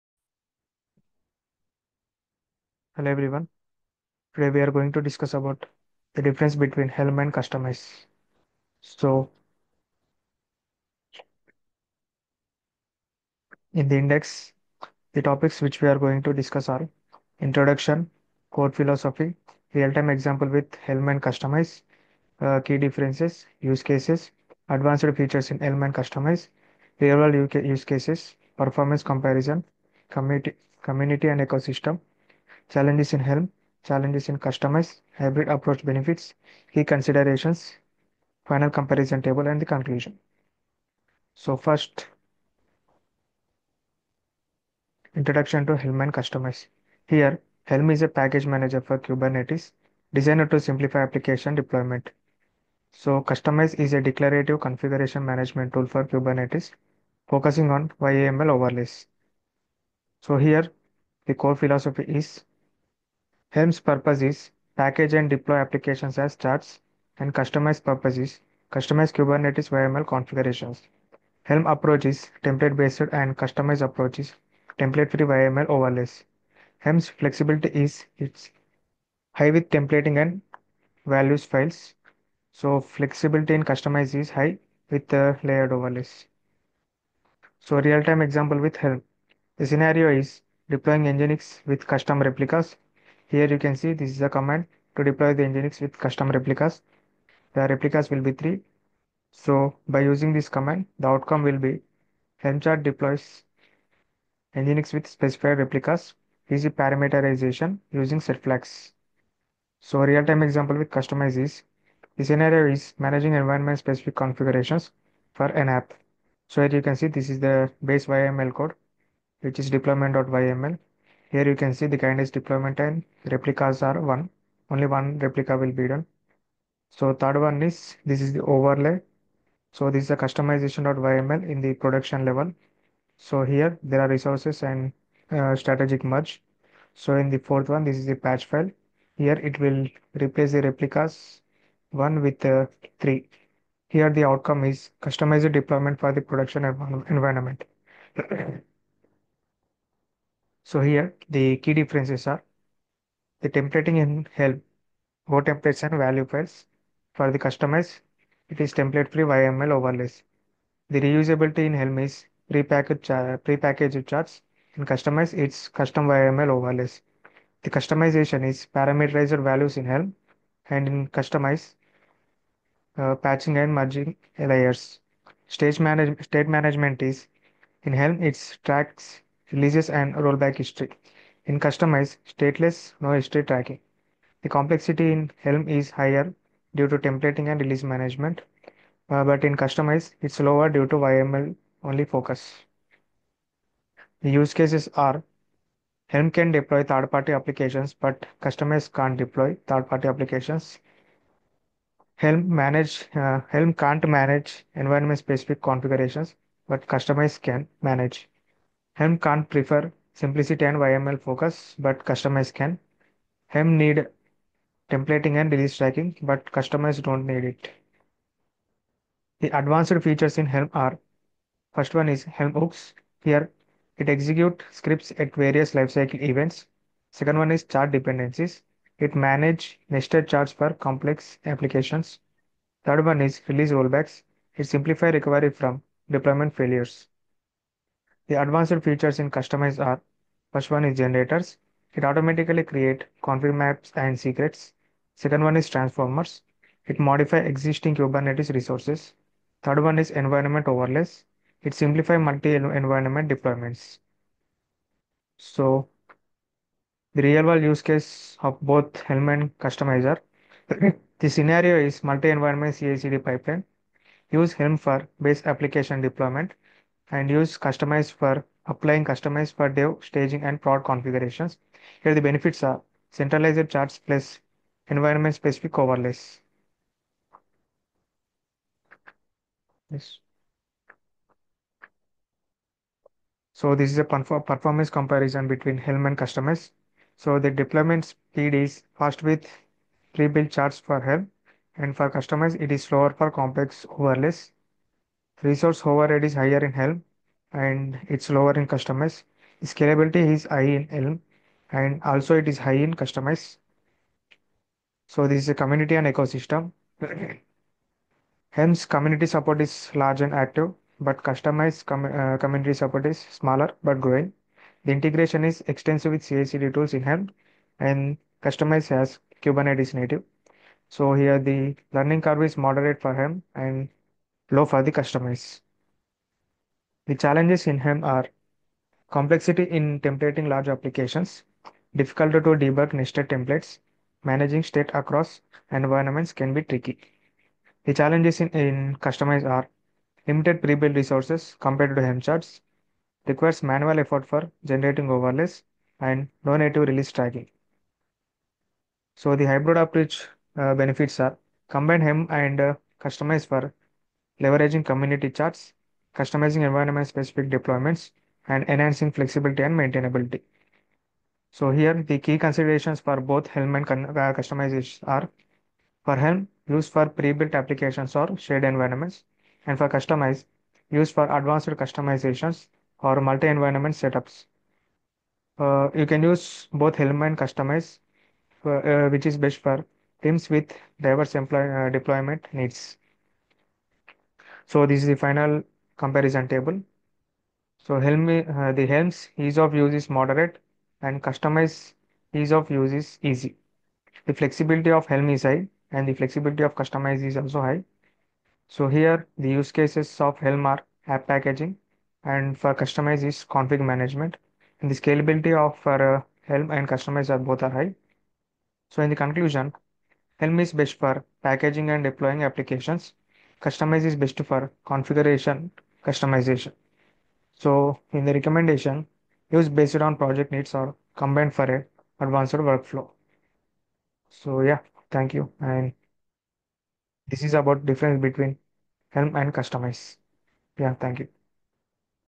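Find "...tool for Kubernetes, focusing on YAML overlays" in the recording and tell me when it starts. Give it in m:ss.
0:55.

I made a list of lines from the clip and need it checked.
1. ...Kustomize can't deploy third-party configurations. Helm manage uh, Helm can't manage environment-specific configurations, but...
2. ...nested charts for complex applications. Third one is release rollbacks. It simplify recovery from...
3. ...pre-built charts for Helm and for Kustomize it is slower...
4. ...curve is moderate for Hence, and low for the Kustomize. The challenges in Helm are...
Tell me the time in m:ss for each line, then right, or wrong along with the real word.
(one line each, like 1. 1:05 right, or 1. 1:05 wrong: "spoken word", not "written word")
1. 3:18 wrong: "applications", not "configurations"
2. 3:49 right
3. 4:50 right
4. 5:22 wrong: "Helm", not "Hence".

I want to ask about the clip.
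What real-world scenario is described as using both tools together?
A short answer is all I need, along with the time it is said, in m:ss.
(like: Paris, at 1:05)
Multi-environment CI/CD pipeline, at 4:22.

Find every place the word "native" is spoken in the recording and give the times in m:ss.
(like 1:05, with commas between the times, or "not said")
5:19, 5:46.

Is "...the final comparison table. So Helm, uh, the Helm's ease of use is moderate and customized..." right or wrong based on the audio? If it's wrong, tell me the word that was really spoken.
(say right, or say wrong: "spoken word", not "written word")
right.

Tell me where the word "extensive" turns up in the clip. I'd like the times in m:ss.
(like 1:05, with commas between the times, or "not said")
5:15.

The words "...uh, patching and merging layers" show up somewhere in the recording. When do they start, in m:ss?
2:52.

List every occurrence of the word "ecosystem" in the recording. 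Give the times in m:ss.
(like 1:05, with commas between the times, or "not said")
0:31, 5:06.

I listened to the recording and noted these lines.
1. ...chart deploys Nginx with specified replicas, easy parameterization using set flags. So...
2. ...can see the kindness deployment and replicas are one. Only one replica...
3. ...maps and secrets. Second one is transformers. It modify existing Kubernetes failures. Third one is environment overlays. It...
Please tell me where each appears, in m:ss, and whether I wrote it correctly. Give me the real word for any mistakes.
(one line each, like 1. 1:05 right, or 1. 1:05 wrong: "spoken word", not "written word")
1. 1:42 right
2. 2:01 right
3. 4:03 wrong: "resources", not "failures".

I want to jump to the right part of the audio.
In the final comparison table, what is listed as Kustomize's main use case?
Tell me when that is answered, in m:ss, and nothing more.
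6:43.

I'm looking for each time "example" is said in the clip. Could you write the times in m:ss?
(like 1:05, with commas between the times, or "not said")
0:20, 1:28, 1:50.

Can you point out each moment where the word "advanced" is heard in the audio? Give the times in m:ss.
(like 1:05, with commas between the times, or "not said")
0:24, 3:39, 3:58, 6:11, 7:02.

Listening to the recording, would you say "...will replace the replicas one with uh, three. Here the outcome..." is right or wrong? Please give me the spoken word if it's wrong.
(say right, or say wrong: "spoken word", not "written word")
right.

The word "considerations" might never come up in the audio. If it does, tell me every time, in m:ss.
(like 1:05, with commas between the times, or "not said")
0:36, 6:02.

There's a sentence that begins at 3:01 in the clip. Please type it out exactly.
In Kustomize, stateless no history tracking.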